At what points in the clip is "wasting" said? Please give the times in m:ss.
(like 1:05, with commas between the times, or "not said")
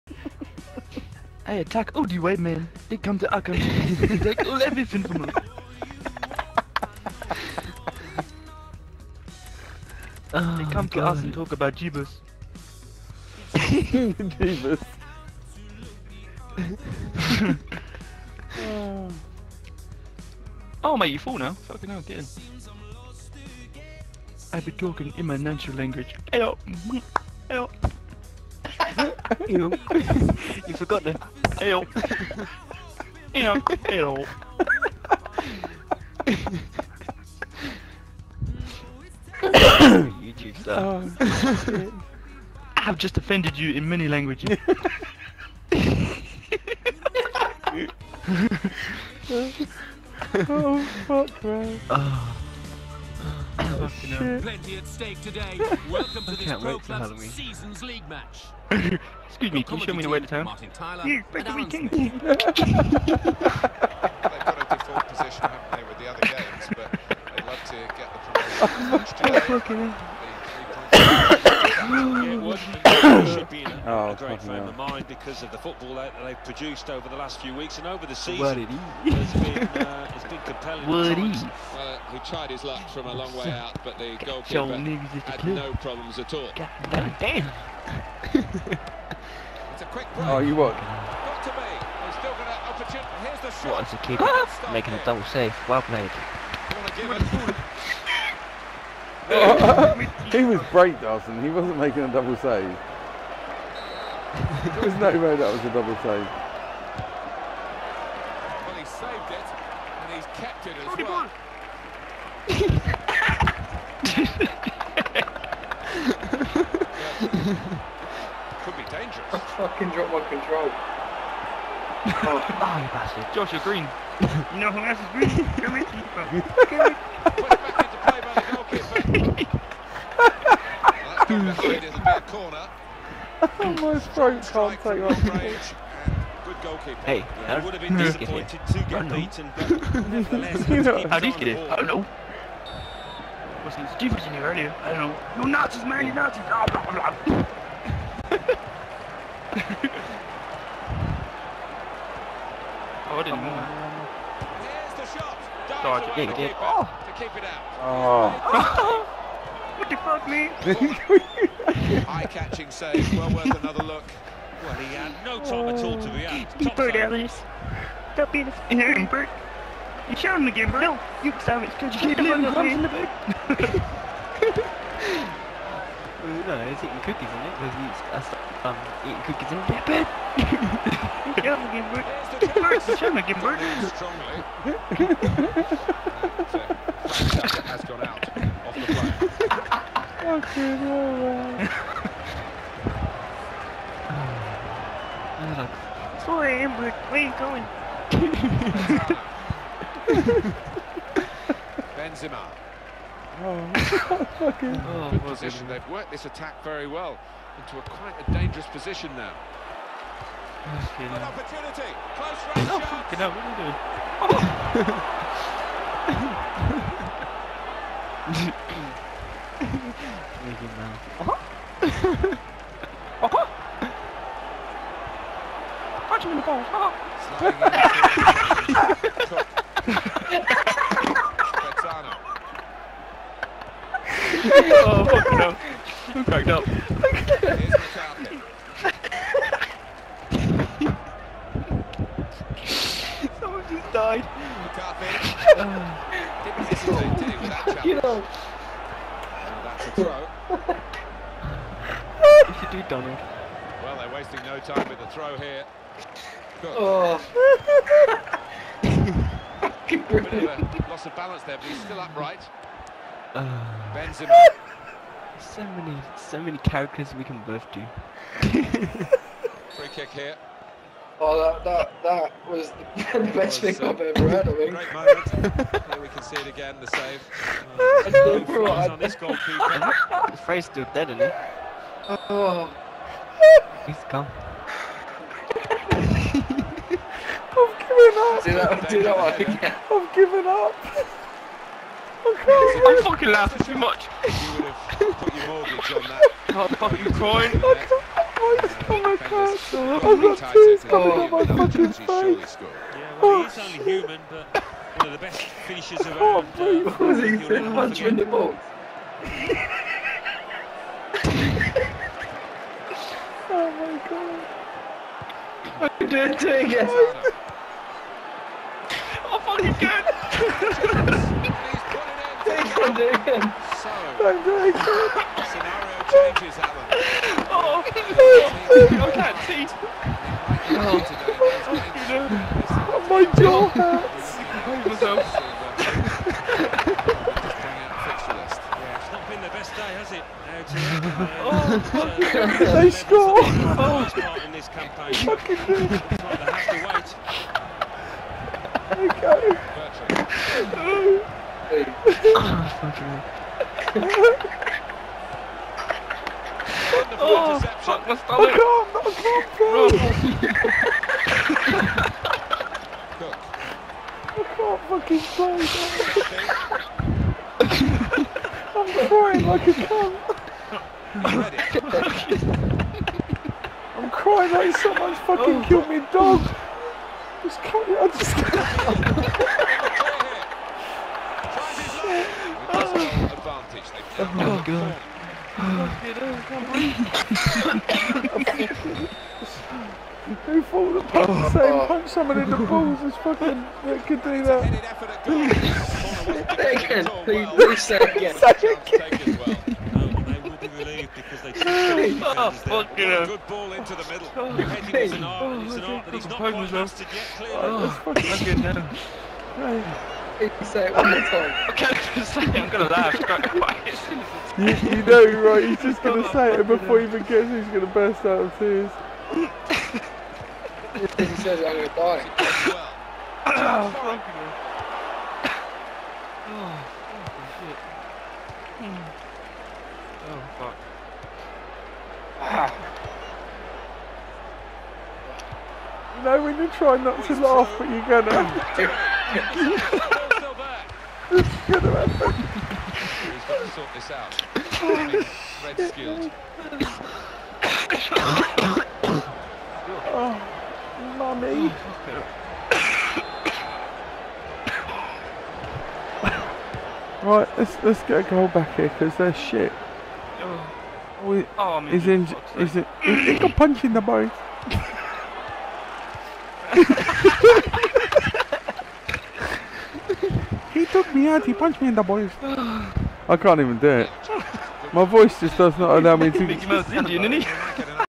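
4:14.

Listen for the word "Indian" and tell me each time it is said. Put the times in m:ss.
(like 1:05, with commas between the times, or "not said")
7:56.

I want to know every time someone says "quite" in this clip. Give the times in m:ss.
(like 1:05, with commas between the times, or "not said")
3:27, 6:46, 6:53.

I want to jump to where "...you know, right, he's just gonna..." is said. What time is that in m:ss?
6:54.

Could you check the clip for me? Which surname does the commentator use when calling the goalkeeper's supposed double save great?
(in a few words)
Dawson.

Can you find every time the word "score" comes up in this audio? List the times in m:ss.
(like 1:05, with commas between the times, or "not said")
5:42.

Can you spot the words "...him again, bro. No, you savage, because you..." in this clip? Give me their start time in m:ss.
2:50.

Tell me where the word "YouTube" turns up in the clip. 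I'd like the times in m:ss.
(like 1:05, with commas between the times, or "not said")
0:40.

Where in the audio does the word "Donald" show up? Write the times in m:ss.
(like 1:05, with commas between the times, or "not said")
4:12.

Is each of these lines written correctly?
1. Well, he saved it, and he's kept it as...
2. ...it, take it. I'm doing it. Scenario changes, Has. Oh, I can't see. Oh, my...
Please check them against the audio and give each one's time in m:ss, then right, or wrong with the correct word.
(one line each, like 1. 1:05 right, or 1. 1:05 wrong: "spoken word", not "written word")
1. 1:48 right
2. 5:22 wrong: "Alan", not "Has".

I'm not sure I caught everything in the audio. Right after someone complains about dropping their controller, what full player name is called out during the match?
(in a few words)
Joshua Green.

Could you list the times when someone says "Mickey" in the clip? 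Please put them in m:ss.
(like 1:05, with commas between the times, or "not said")
3:40, 7:56.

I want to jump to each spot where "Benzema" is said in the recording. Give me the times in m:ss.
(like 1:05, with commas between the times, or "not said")
3:21, 4:23.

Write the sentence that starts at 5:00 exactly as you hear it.
I've got tears coming oh, out my fucking face.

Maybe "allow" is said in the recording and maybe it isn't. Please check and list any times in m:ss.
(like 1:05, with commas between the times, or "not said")
7:55.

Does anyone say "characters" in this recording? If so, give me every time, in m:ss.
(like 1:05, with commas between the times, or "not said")
4:26.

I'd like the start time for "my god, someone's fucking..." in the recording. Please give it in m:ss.
6:14.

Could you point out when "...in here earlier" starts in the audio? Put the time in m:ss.
2:24.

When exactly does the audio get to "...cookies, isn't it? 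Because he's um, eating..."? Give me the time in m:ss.
2:57.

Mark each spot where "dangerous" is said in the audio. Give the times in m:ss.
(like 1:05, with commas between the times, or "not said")
1:58, 3:28.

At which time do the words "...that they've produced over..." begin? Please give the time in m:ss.
1:15.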